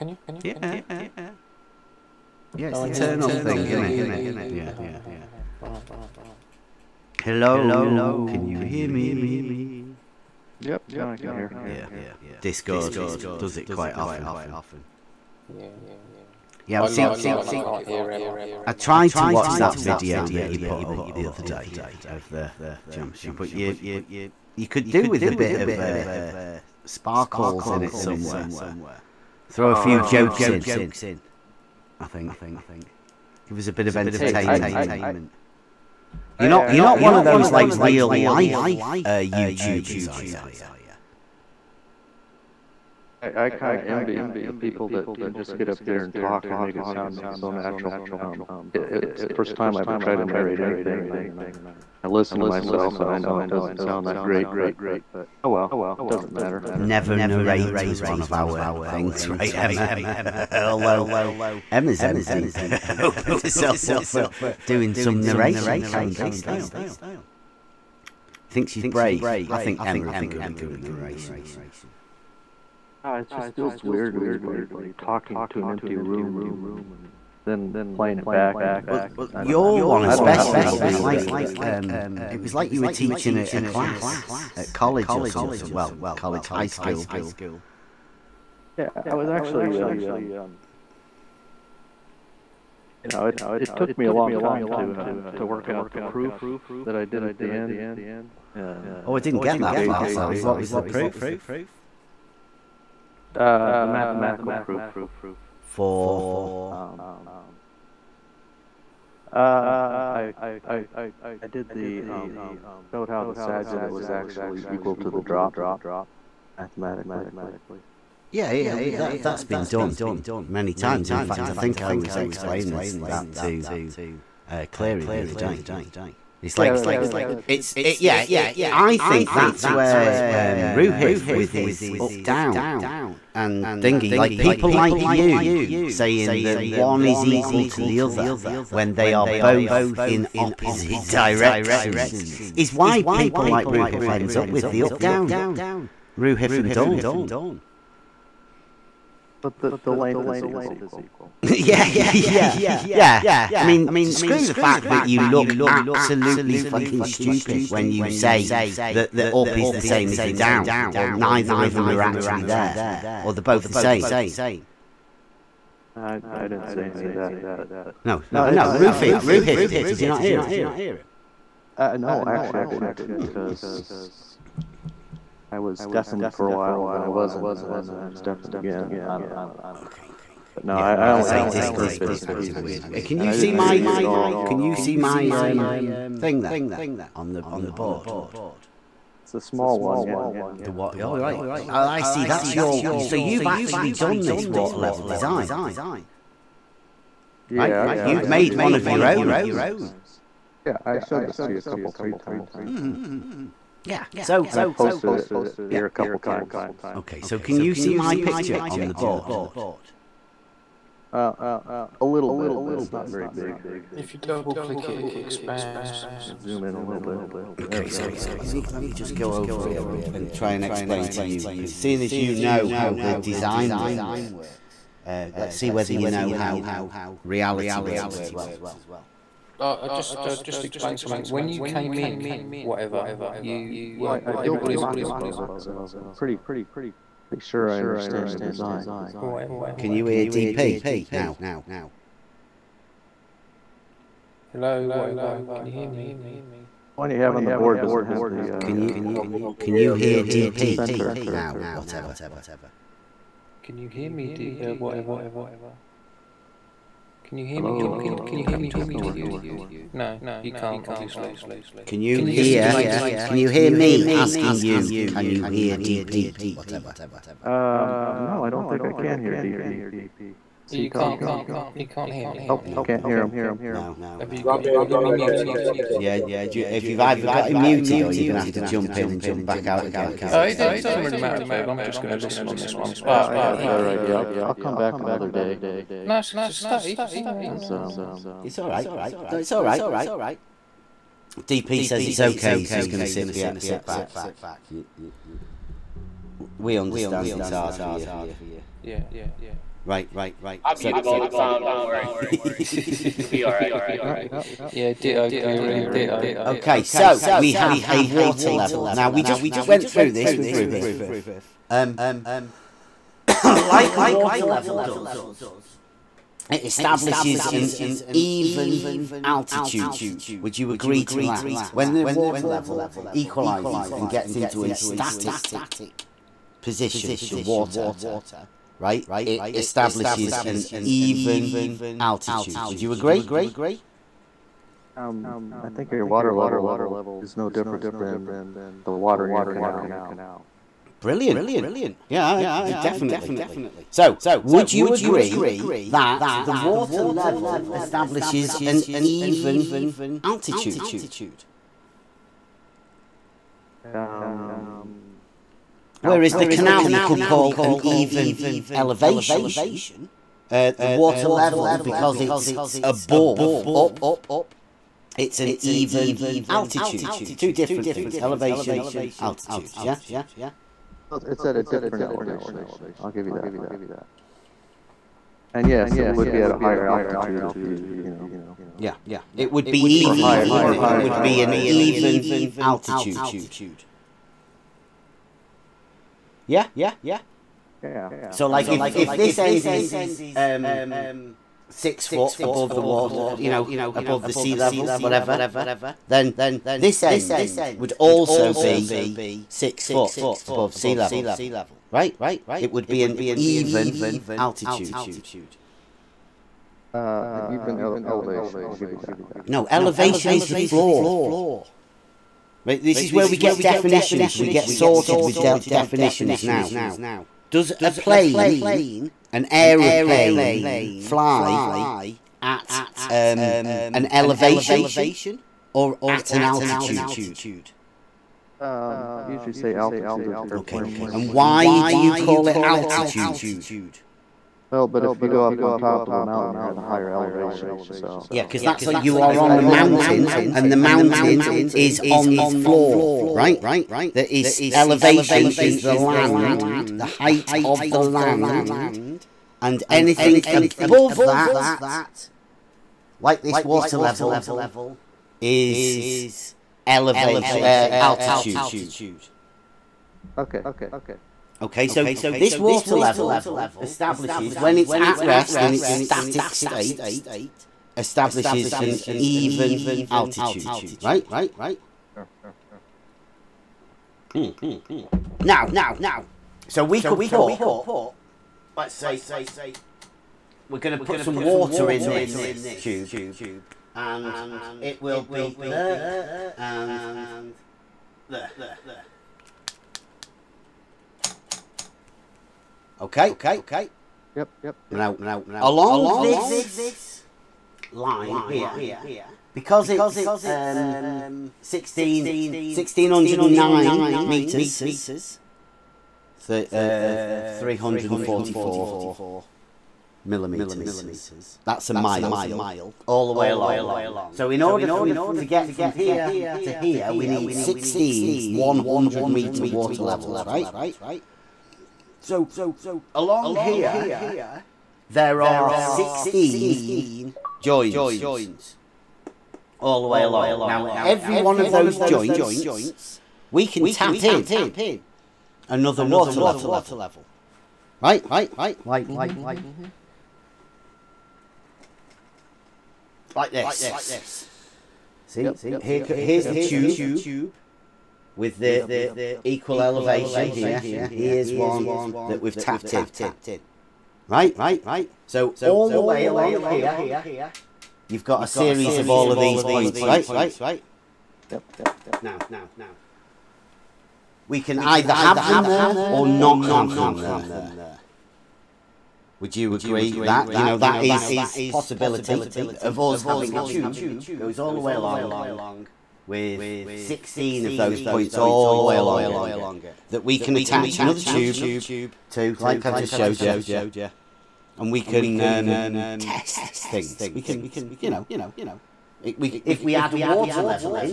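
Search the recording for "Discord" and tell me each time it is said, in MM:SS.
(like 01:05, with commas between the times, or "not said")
00:12, 03:01.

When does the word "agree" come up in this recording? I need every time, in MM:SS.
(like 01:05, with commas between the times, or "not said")
05:20, 05:32, 05:44, 09:29.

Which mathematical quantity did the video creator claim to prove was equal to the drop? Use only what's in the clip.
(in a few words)
Sagitta.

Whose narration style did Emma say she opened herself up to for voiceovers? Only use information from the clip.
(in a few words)
Karen B.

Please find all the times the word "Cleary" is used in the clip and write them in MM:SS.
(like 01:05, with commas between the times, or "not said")
02:04, 05:05.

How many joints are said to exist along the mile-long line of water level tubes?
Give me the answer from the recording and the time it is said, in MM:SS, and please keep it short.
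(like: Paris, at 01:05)
16, at 08:45.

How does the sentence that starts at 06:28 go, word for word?
So, like, I mean, if it's...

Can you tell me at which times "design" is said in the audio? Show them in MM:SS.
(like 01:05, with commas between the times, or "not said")
03:15, 03:43, 03:58.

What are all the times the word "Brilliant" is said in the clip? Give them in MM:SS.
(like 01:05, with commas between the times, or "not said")
05:41.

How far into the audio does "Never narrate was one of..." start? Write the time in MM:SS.
00:56.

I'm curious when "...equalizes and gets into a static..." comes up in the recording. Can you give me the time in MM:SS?
05:23.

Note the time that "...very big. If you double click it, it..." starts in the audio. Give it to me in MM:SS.
03:33.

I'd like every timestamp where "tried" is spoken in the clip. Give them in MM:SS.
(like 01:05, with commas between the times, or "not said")
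00:18, 00:49.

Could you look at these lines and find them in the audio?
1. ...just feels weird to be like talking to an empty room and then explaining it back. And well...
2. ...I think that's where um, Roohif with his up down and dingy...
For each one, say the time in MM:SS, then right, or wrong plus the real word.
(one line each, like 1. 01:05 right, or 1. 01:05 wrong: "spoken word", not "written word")
1. 01:13 wrong: "playing", not "explaining"
2. 02:08 right.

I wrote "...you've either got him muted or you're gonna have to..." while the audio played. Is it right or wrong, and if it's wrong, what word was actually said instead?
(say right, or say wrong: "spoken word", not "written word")
right.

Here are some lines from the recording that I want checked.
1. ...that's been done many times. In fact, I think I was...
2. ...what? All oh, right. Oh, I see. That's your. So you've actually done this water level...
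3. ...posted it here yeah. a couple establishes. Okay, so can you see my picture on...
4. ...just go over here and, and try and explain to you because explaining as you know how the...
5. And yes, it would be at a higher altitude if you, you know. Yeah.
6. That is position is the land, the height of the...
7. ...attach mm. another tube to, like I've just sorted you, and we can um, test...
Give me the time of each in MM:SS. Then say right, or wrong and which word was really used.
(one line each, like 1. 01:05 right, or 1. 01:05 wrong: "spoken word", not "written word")
1. 01:59 right
2. 03:10 right
3. 03:24 wrong: "times", not "establishes"
4. 03:38 wrong: "seeing", not "explaining"
5. 06:15 right
6. 07:24 wrong: "elevation", not "position"
7. 09:40 wrong: "showed", not "sorted".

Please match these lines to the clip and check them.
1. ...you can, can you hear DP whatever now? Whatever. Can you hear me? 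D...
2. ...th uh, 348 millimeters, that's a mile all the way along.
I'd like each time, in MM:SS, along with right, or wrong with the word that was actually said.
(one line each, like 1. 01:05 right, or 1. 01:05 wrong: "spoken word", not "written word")
1. 04:09 wrong: "center", not "whatever"
2. 08:26 wrong: "344", not "348".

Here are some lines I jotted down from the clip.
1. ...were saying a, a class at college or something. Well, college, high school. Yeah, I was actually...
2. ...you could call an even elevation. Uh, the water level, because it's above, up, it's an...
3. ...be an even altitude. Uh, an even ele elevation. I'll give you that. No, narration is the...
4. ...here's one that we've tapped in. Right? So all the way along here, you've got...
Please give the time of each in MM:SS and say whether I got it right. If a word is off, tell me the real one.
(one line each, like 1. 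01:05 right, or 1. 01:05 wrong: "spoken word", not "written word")
1. 01:22 wrong: "teaching", not "saying"
2. 05:56 right
3. 06:42 wrong: "elevation", not "narration"
4. 09:11 right.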